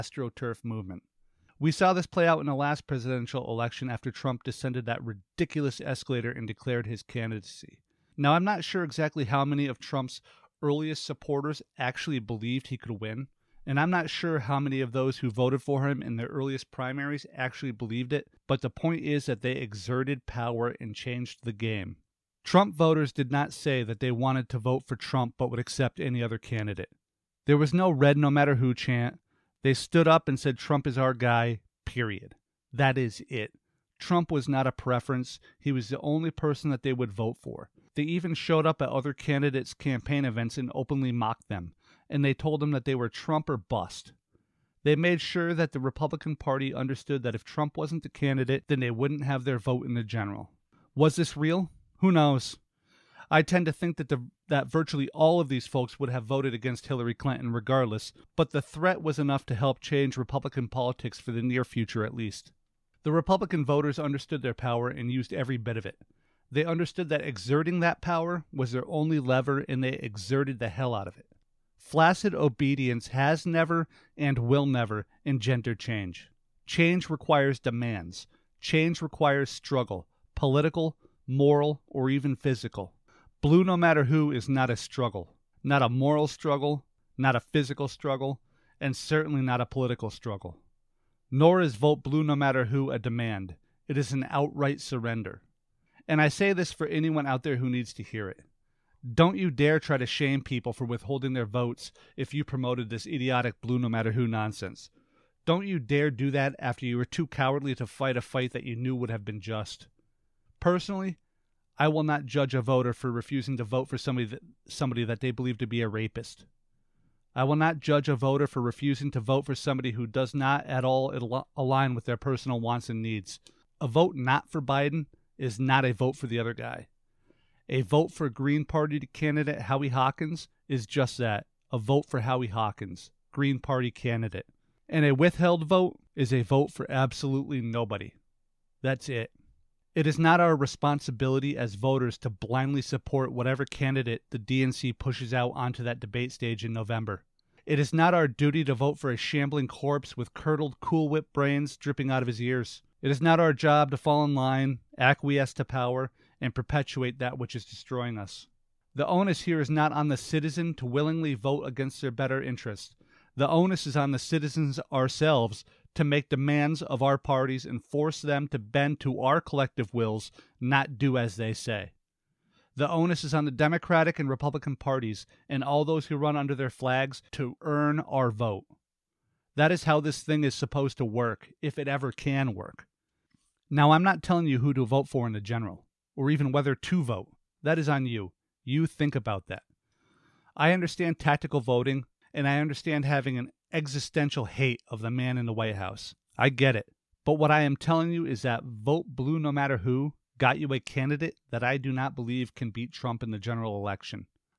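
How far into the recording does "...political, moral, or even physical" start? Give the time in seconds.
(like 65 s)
80 s.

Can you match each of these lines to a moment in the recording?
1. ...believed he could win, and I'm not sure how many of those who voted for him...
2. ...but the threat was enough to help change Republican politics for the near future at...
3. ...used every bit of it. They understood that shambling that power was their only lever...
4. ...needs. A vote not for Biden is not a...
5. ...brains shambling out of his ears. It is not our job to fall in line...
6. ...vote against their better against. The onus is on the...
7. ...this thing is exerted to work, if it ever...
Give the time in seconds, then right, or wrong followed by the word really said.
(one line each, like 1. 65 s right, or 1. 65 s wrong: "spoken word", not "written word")
1. 12 s right
2. 58 s right
3. 65 s wrong: "exerting", not "shambling"
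4. 123 s right
5. 151 s wrong: "dripping", not "shambling"
6. 161 s wrong: "interest", not "against"
7. 179 s wrong: "supposed", not "exerted".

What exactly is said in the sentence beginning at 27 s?
There was no red no matter who chant.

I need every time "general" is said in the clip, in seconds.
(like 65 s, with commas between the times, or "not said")
50 s, 185 s, 203 s.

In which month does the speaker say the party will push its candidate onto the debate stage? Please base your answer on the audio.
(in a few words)
November.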